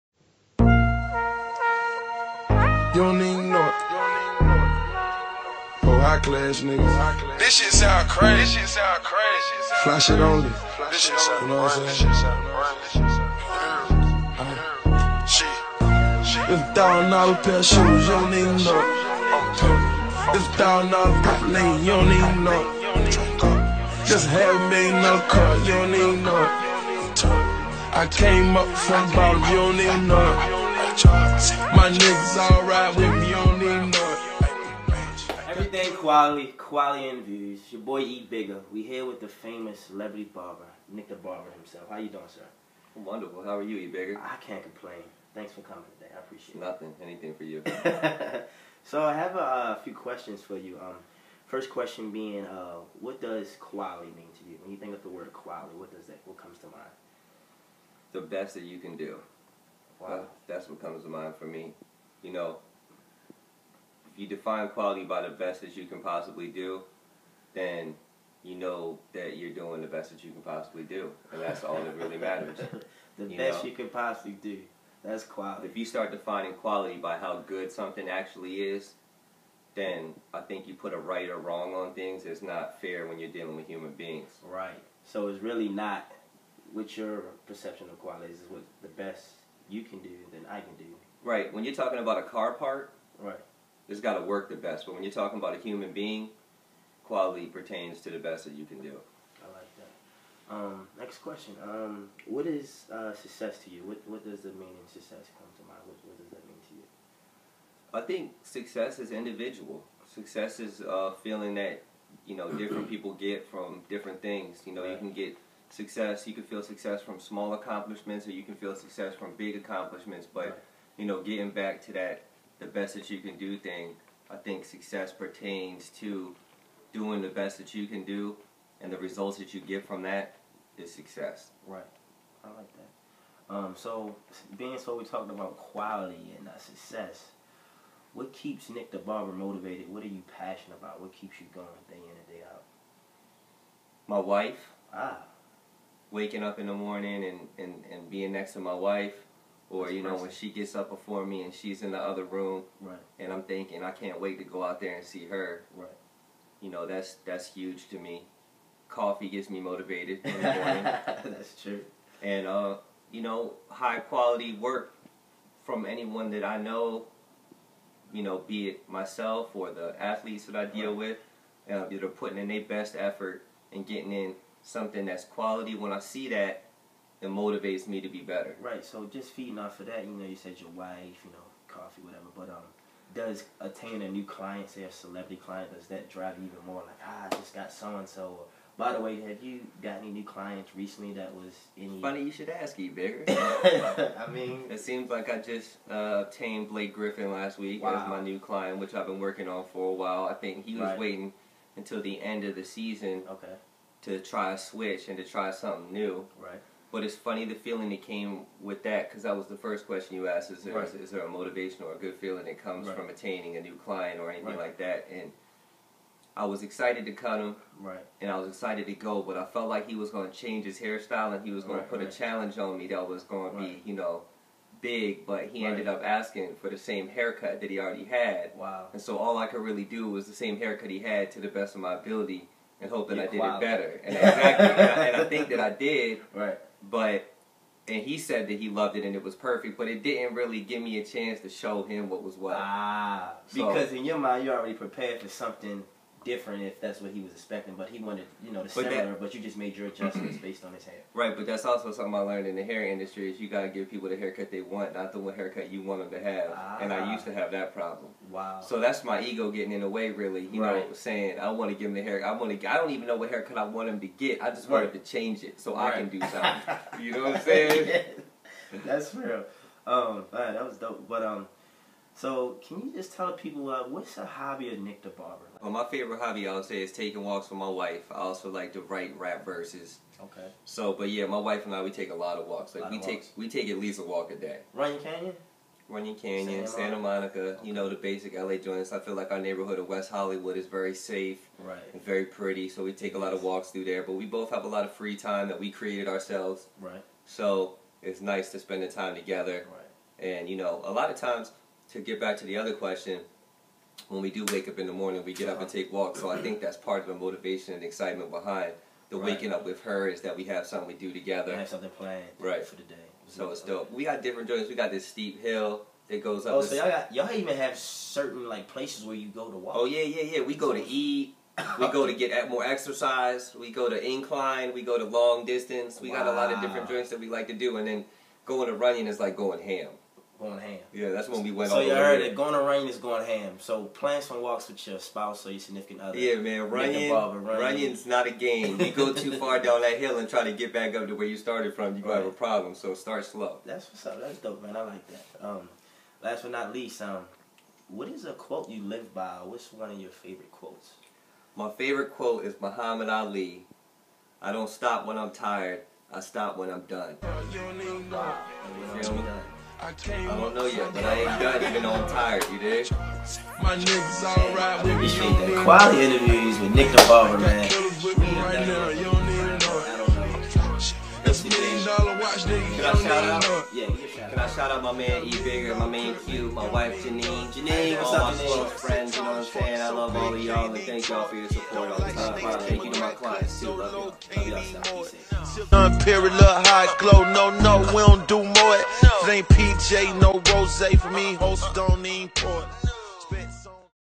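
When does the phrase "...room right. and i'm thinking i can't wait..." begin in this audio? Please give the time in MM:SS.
02:32.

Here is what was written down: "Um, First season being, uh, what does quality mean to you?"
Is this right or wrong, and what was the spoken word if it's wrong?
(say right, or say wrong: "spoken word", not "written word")
wrong: "question", not "season".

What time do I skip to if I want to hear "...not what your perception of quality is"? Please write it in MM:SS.
01:25.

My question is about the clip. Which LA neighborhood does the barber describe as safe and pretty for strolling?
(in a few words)
West Hollywood.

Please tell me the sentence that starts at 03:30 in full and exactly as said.
is, is there a motivation or a good feeling that comes right.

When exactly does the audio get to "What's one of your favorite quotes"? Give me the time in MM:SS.
05:49.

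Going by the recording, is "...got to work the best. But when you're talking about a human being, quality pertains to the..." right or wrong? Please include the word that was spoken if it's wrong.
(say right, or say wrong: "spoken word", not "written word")
right.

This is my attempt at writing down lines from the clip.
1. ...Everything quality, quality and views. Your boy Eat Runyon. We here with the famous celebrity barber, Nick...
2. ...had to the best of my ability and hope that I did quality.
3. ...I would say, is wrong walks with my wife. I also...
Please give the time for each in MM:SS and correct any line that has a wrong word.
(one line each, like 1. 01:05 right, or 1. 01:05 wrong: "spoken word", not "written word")
1. 00:35 wrong: "Bigger", not "Runyon"
2. 03:50 right
3. 04:36 wrong: "taking", not "wrong".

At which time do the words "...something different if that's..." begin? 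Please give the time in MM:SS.
04:05.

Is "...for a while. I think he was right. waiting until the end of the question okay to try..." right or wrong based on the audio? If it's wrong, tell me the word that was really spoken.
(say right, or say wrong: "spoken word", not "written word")
wrong: "season", not "question".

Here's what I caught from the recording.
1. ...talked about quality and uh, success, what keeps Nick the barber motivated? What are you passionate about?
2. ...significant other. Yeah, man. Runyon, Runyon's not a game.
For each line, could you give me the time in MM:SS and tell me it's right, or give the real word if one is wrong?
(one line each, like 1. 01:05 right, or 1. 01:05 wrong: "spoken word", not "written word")
1. 02:15 right
2. 05:35 right.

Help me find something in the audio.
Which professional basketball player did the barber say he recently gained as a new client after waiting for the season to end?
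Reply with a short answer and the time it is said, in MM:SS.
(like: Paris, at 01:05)
Blake Griffin, at 03:16.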